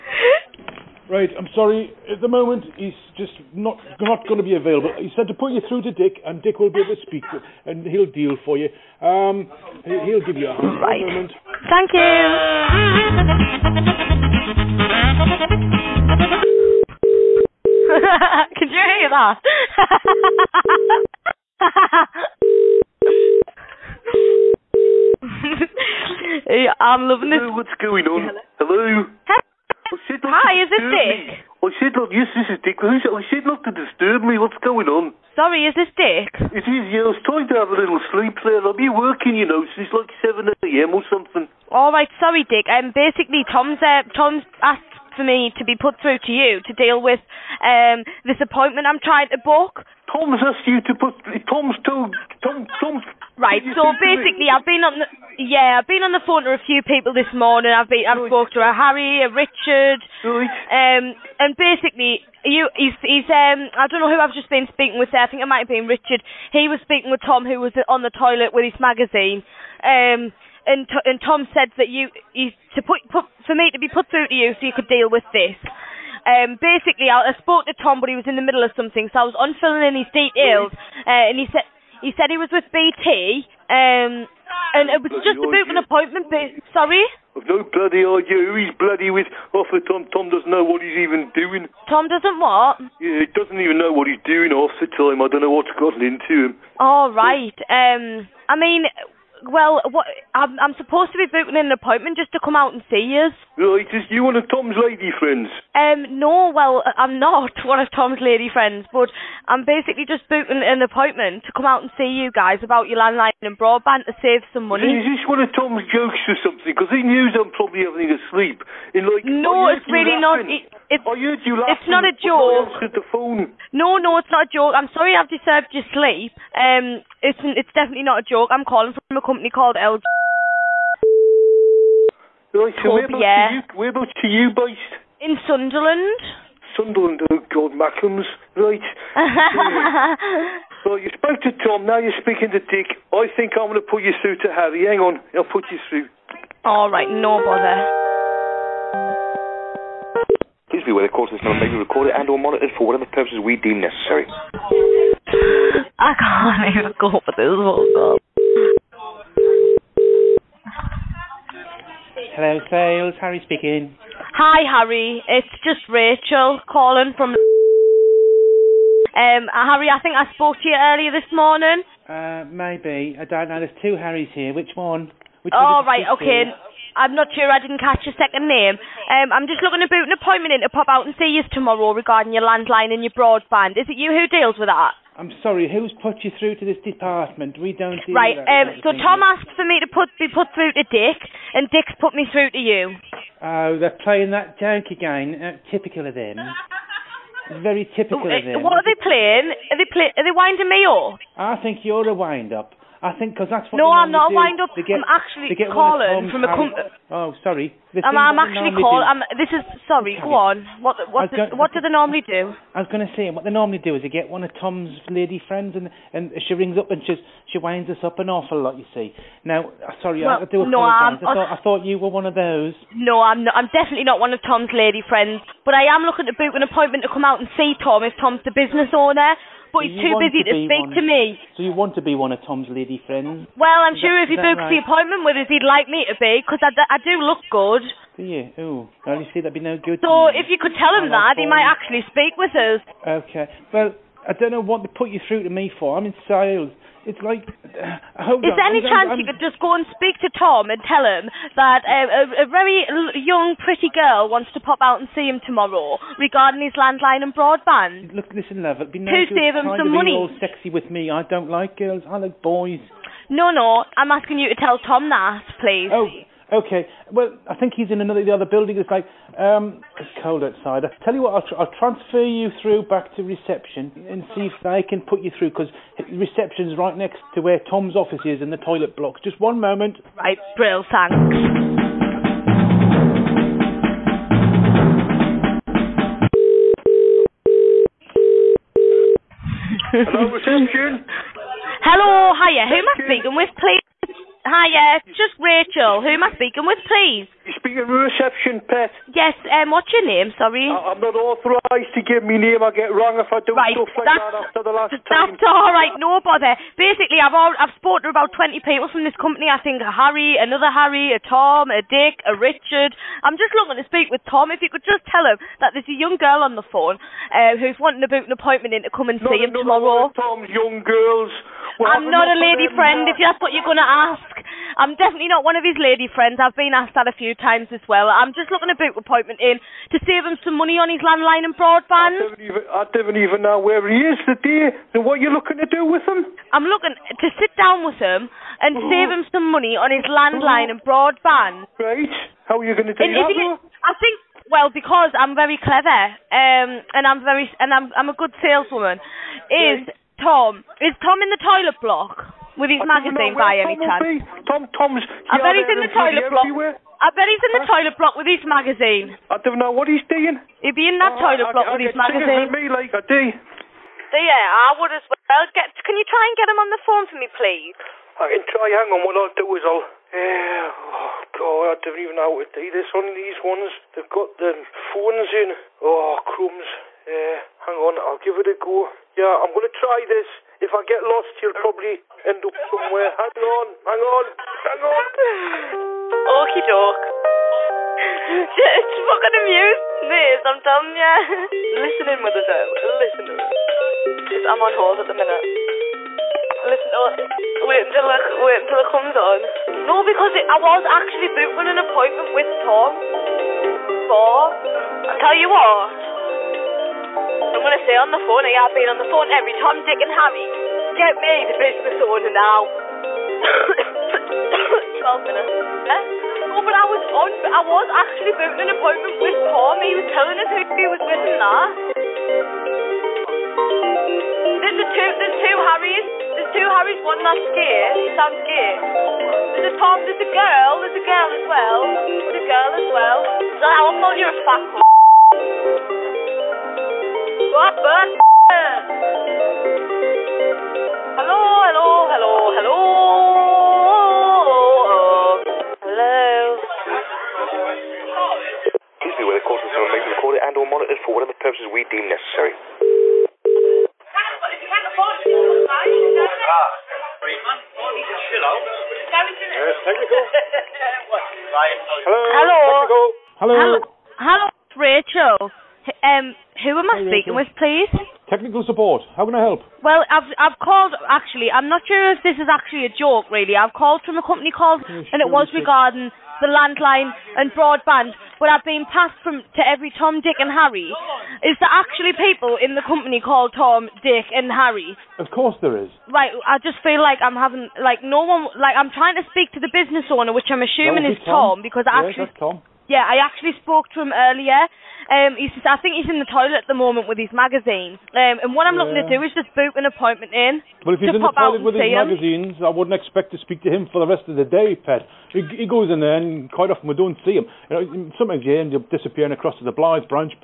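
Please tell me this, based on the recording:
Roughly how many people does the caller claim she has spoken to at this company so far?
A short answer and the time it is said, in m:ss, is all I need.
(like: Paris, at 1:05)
20, at 5:08.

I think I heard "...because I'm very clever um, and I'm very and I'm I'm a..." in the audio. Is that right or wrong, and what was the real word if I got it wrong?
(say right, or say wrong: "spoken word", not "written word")
right.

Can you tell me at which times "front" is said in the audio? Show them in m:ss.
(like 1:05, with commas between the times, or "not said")
not said.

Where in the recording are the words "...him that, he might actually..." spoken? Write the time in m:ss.
4:00.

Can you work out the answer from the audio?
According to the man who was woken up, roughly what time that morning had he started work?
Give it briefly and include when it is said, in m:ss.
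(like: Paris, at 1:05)
7 a.m., at 0:40.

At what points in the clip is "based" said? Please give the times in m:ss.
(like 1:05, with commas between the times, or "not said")
2:14.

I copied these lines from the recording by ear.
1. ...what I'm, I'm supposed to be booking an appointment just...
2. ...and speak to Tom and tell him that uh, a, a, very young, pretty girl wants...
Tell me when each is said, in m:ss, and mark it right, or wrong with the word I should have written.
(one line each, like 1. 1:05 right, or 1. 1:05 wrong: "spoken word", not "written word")
1. 1:39 right
2. 4:09 right.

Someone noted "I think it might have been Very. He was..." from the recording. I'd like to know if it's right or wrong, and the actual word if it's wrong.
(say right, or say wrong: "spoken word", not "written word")
wrong: "Richard", not "Very".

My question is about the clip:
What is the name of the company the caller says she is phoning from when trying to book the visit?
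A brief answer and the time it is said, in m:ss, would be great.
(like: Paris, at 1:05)
LG, at 2:09.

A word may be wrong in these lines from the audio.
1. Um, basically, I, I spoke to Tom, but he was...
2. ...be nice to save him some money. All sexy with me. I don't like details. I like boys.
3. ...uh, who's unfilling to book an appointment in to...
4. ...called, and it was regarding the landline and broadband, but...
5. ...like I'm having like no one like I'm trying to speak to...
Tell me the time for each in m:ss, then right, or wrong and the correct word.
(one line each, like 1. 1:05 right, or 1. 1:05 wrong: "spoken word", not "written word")
1. 1:16 right
2. 4:18 wrong: "girls", not "details"
3. 5:17 wrong: "wanting", not "unfilling"
4. 7:54 right
5. 8:06 right.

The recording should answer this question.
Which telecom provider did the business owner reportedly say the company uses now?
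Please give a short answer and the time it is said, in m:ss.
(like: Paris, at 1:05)
BT, at 1:22.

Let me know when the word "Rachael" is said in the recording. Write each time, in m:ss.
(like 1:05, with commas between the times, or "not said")
2:45, 4:55.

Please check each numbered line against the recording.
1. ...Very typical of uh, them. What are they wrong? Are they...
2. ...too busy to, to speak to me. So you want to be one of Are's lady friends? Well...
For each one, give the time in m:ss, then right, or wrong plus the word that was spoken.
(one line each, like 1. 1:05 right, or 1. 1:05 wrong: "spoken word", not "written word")
1. 3:17 wrong: "playing", not "wrong"
2. 3:49 wrong: "Tom", not "Are".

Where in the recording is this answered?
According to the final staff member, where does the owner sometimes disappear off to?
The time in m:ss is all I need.
8:29.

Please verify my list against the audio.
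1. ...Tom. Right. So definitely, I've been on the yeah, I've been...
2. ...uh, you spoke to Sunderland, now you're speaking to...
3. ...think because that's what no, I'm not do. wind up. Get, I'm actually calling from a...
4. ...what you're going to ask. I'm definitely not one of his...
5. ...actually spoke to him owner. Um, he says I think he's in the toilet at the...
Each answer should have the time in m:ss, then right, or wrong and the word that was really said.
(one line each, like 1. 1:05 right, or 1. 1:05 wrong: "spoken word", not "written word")
1. 0:52 wrong: "basically", not "definitely"
2. 2:20 wrong: "Tom", not "Sunderland"
3. 3:23 right
4. 5:23 right
5. 8:13 wrong: "earlier", not "owner".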